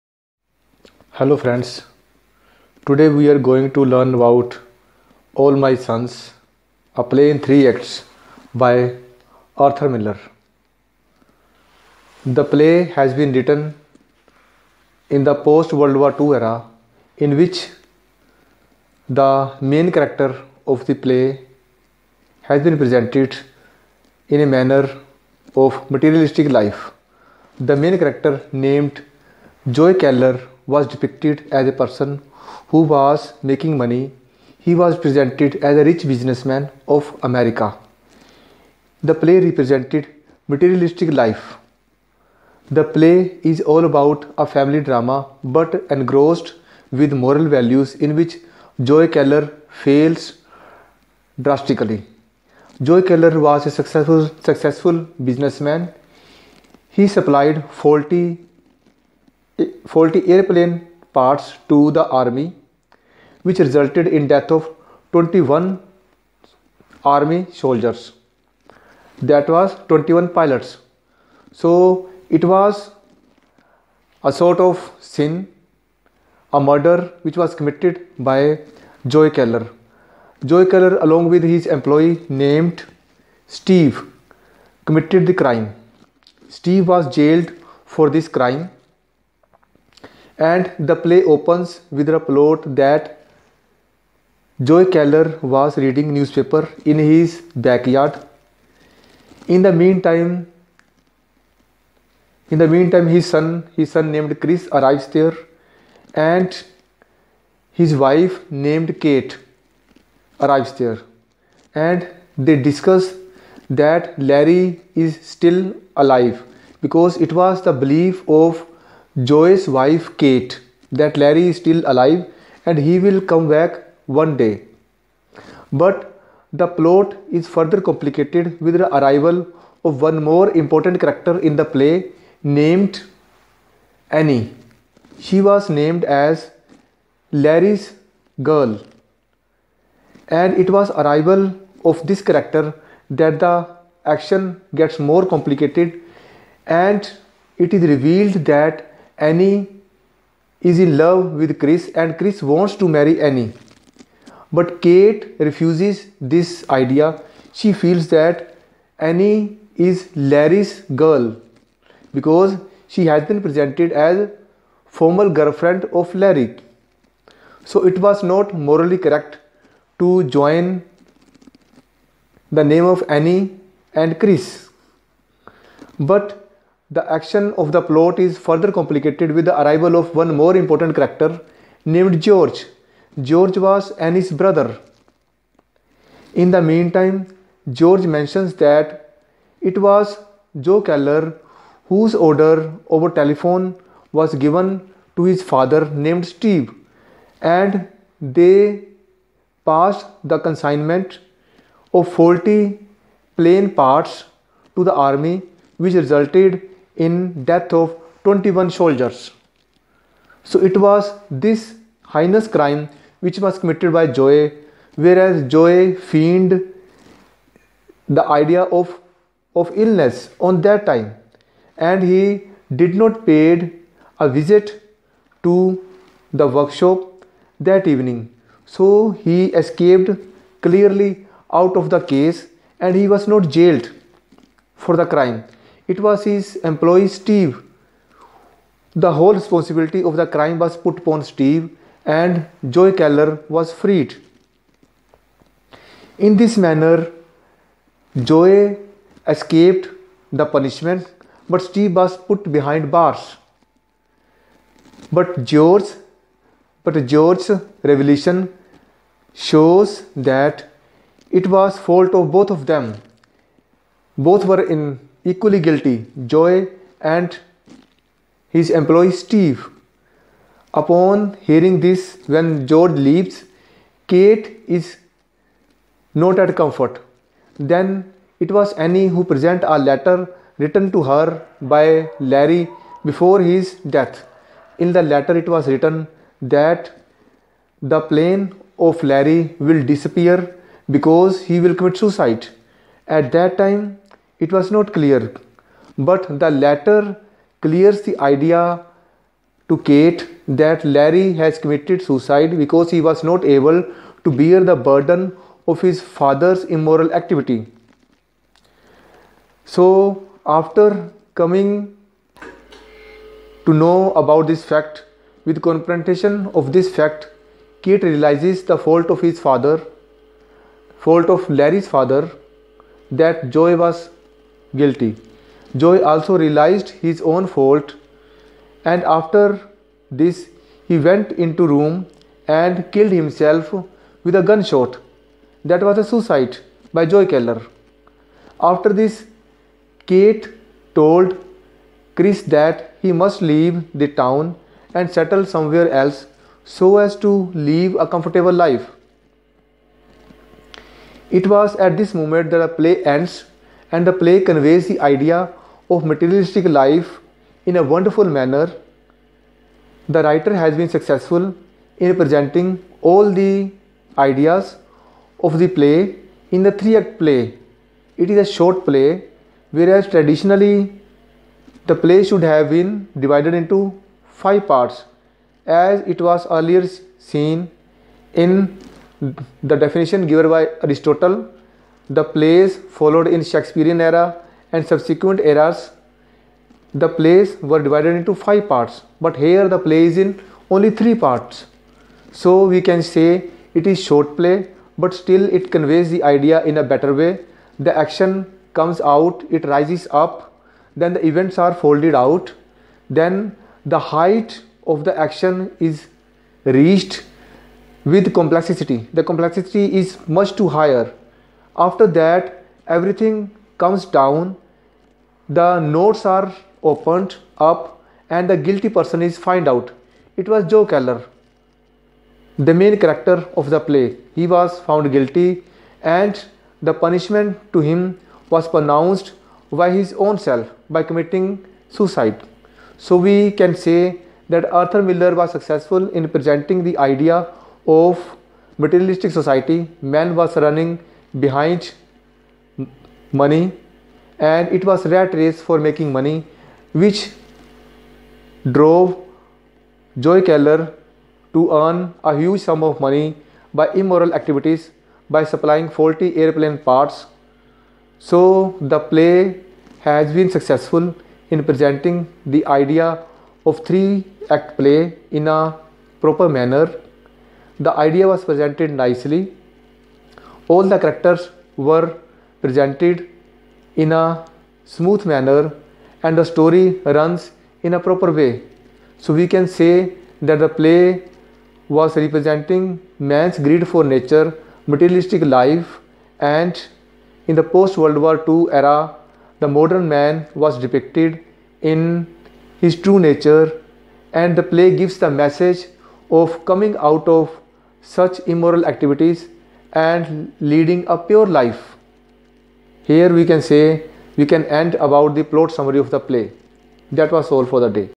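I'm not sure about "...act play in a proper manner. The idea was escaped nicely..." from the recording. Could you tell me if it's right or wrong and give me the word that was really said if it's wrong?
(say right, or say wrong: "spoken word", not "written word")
wrong: "presented", not "escaped".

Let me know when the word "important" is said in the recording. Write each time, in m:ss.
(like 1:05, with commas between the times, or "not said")
2:10, 3:00.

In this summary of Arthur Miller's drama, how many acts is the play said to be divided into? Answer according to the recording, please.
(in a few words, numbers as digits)
3.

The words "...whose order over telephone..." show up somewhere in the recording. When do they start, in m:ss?
3:11.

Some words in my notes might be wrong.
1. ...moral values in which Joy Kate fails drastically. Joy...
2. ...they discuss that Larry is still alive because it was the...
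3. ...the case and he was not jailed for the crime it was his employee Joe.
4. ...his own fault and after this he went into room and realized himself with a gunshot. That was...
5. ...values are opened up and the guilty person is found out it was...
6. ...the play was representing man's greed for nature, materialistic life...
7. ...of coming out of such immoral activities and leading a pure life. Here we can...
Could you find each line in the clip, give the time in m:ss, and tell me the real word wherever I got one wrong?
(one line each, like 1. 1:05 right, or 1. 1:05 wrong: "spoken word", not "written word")
1. 0:47 wrong: "Keller", not "Kate"
2. 1:52 right
3. 3:51 wrong: "Steve", not "Joe"
4. 5:27 wrong: "killed", not "realized"
5. 6:55 wrong: "notes", not "values"
6. 8:00 right
7. 8:16 right.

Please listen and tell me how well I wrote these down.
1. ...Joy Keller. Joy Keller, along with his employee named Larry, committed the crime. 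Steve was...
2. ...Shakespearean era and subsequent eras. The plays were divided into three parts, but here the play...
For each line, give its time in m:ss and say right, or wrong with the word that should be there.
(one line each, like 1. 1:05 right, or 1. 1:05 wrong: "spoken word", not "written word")
1. 1:19 wrong: "Steve", not "Larry"
2. 6:23 wrong: "five", not "three".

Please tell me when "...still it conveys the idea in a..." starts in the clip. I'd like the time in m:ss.
6:35.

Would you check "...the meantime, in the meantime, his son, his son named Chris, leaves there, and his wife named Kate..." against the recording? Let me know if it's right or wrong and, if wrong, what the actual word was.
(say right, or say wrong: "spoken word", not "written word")
wrong: "arrives", not "leaves".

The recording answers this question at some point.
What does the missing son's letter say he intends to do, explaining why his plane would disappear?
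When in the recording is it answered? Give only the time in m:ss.
4:51.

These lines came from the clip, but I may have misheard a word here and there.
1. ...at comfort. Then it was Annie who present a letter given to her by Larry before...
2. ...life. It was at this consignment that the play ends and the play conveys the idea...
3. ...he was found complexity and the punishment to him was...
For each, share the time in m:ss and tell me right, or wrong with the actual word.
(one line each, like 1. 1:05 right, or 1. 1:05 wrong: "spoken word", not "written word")
1. 4:36 wrong: "written", not "given"
2. 5:48 wrong: "moment", not "consignment"
3. 7:04 wrong: "guilty", not "complexity".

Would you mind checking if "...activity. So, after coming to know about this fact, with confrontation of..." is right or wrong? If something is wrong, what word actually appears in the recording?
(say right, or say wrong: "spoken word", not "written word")
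right.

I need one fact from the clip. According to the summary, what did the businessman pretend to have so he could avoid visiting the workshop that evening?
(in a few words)
illness.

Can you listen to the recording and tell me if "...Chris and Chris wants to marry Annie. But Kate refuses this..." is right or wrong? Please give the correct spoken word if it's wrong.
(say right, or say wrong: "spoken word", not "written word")
right.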